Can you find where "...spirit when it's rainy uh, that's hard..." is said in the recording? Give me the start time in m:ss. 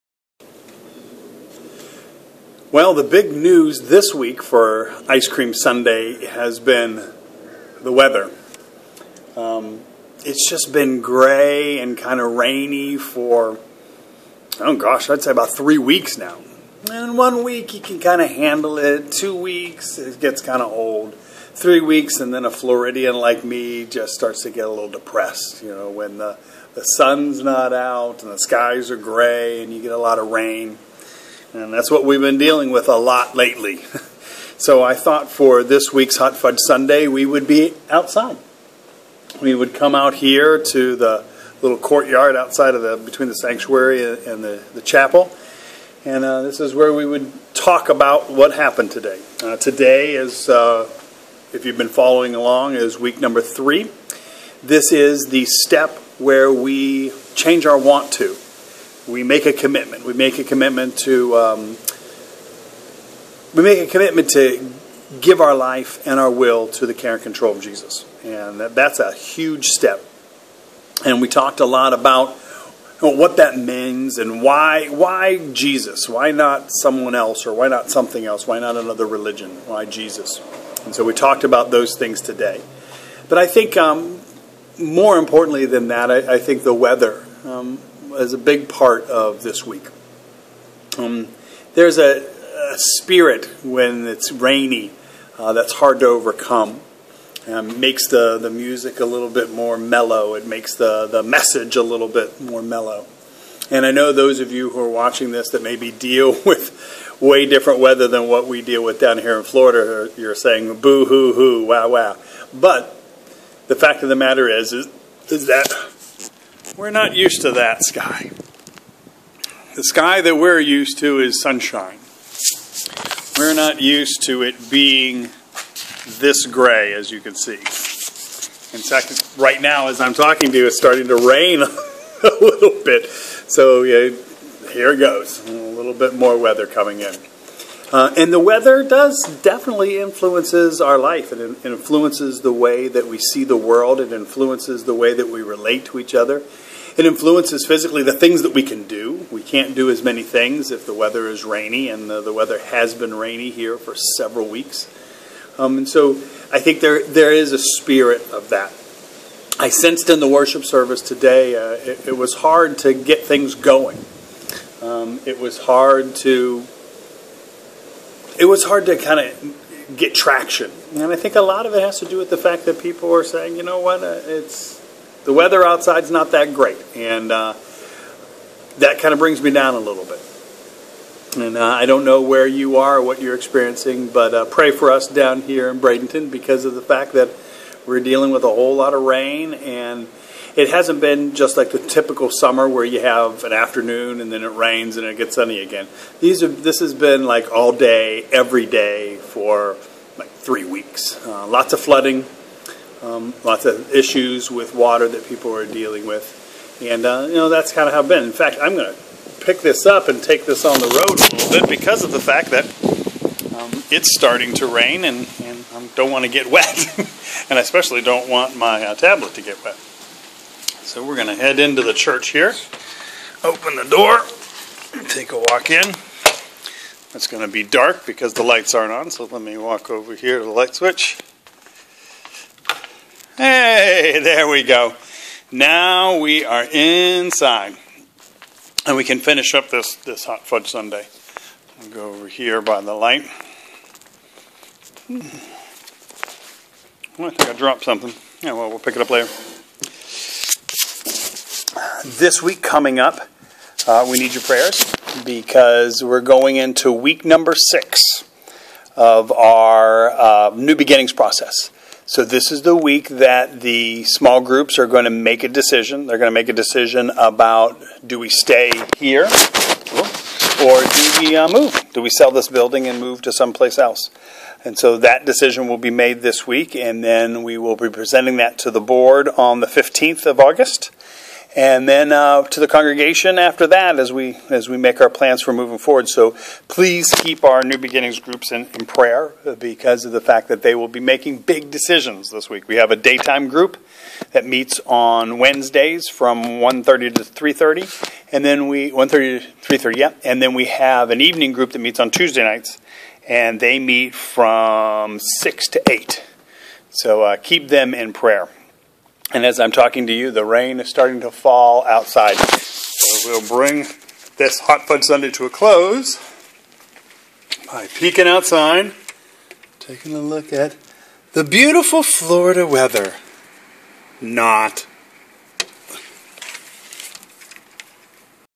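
1:32.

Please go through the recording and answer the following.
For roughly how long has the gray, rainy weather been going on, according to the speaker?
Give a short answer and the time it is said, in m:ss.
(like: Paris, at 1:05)
3 weeks, at 0:15.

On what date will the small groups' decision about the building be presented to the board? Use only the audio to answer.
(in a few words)
August 15.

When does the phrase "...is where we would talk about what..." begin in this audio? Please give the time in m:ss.
0:46.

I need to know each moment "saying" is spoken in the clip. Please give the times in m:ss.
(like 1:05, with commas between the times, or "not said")
1:50, 2:53.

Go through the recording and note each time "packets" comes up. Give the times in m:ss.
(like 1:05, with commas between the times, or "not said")
not said.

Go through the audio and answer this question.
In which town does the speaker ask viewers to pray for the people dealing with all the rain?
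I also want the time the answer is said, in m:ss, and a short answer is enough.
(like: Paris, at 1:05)
Bradenton, at 3:05.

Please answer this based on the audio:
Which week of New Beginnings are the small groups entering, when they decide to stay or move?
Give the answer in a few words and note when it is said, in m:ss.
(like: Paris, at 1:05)
6, at 4:16.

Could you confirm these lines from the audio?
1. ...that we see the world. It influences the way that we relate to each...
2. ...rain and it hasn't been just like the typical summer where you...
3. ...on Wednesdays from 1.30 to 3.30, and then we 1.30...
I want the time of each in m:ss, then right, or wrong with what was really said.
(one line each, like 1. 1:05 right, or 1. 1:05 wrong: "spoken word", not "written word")
1. 2:22 right
2. 3:09 right
3. 4:54 right.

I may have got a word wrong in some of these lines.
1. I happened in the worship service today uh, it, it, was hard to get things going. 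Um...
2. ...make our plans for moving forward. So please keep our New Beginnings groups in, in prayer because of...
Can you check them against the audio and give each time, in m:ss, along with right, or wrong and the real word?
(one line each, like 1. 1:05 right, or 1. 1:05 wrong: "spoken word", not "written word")
1. 2:39 wrong: "sensed", not "happened"
2. 4:44 right.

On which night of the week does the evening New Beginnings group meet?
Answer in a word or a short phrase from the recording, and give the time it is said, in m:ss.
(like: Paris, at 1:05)
Tuesday, at 5:02.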